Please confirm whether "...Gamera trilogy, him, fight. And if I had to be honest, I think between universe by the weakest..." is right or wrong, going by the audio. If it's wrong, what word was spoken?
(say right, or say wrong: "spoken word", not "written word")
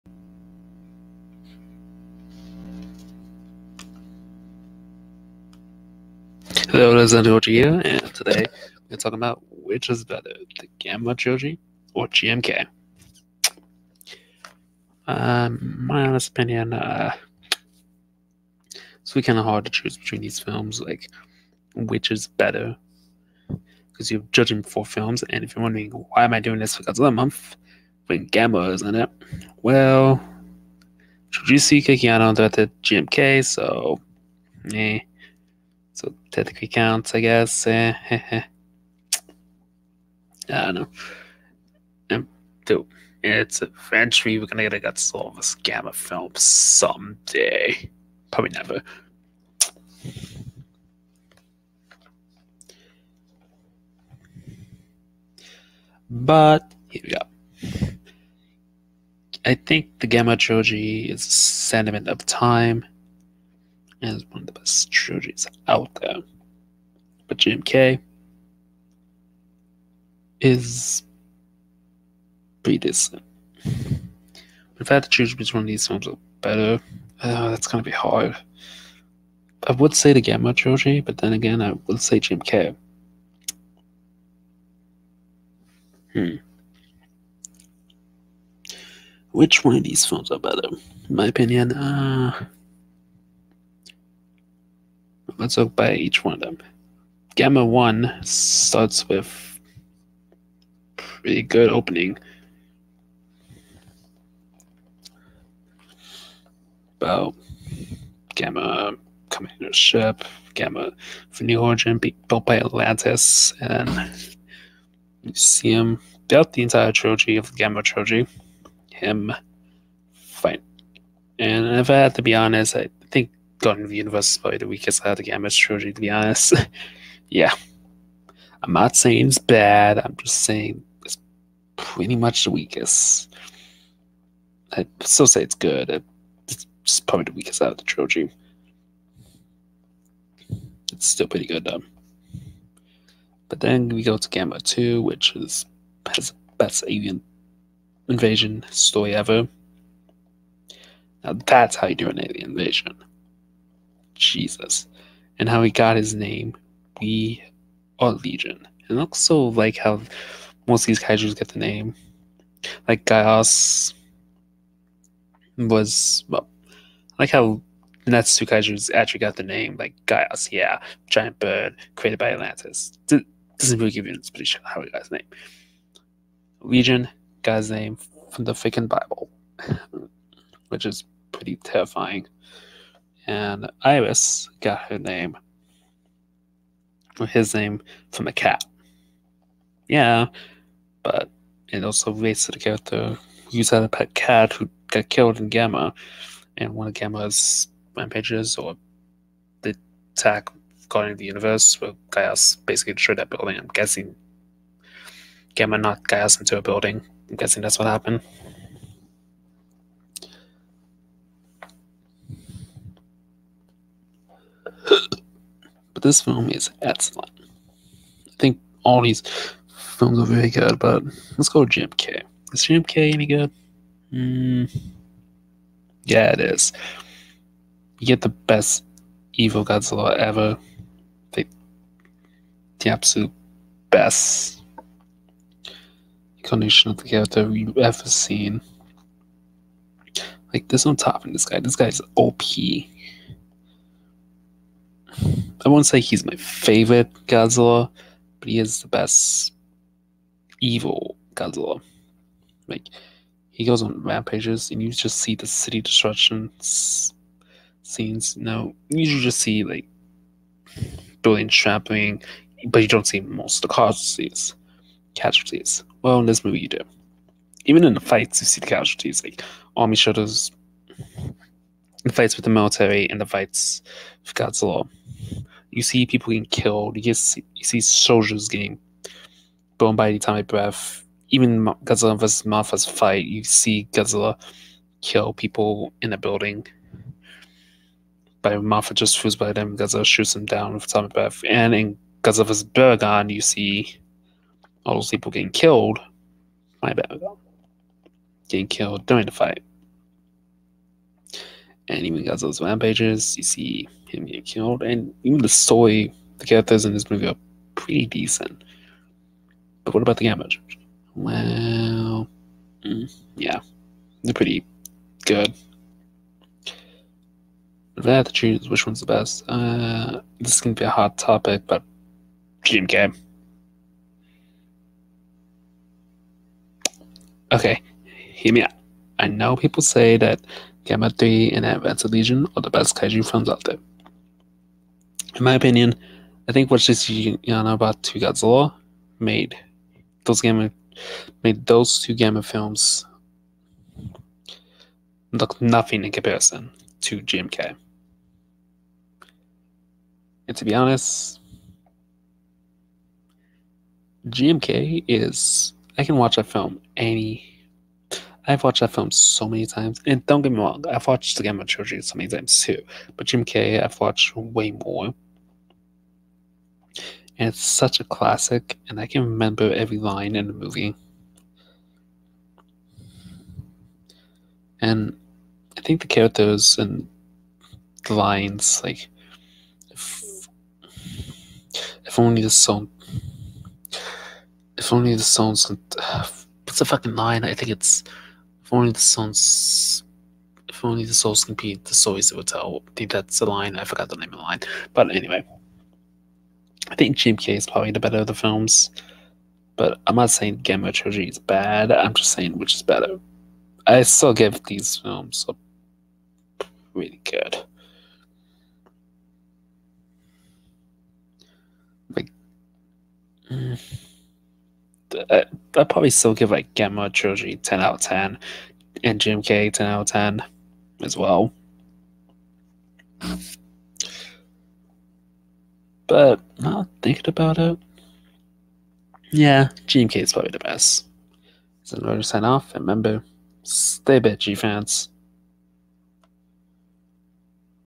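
wrong: "gotten", not "between".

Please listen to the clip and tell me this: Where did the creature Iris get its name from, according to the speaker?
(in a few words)
A cat.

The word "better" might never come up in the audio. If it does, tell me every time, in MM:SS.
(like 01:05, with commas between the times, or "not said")
00:10, 00:22, 01:16, 01:30, 06:37, 06:42.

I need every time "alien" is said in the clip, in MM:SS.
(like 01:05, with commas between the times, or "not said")
02:26, 02:32.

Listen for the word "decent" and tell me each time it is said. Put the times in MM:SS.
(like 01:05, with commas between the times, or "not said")
01:12, 05:08.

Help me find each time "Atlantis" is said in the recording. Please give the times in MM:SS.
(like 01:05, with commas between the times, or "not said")
01:52, 02:52.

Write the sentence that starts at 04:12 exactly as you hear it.
Like he goes on rampages, and you just see the city destruction scenes.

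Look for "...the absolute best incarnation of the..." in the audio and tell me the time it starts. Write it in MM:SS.
03:52.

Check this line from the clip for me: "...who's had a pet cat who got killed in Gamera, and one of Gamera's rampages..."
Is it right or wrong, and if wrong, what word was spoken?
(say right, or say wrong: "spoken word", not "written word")
right.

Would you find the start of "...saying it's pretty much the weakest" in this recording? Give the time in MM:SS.
02:10.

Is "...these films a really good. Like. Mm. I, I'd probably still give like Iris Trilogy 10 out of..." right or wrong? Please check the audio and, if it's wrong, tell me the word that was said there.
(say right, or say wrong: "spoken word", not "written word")
wrong: "Gamera", not "Iris".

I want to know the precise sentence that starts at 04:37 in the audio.
You see, you see soldiers getting blown by the atomic breath.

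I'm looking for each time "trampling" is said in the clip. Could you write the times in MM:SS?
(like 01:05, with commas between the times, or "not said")
04:21.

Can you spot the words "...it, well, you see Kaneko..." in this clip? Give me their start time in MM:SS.
00:28.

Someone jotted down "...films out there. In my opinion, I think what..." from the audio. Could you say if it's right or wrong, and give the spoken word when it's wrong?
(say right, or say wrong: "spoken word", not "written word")
right.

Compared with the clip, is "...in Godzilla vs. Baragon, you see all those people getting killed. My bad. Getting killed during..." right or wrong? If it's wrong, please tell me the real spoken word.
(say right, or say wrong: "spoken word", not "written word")
right.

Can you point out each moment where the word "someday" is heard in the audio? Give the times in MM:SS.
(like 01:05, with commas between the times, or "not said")
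00:46.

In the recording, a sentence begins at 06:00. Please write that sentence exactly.
And don't get me wrong, I've watched the Gamera Trilogy so many times too.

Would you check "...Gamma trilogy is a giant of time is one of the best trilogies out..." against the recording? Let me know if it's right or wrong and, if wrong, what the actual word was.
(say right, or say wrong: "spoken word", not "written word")
wrong: "sentiment", not "giant".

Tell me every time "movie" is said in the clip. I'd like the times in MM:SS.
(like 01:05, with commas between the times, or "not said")
04:26, 05:07, 06:10.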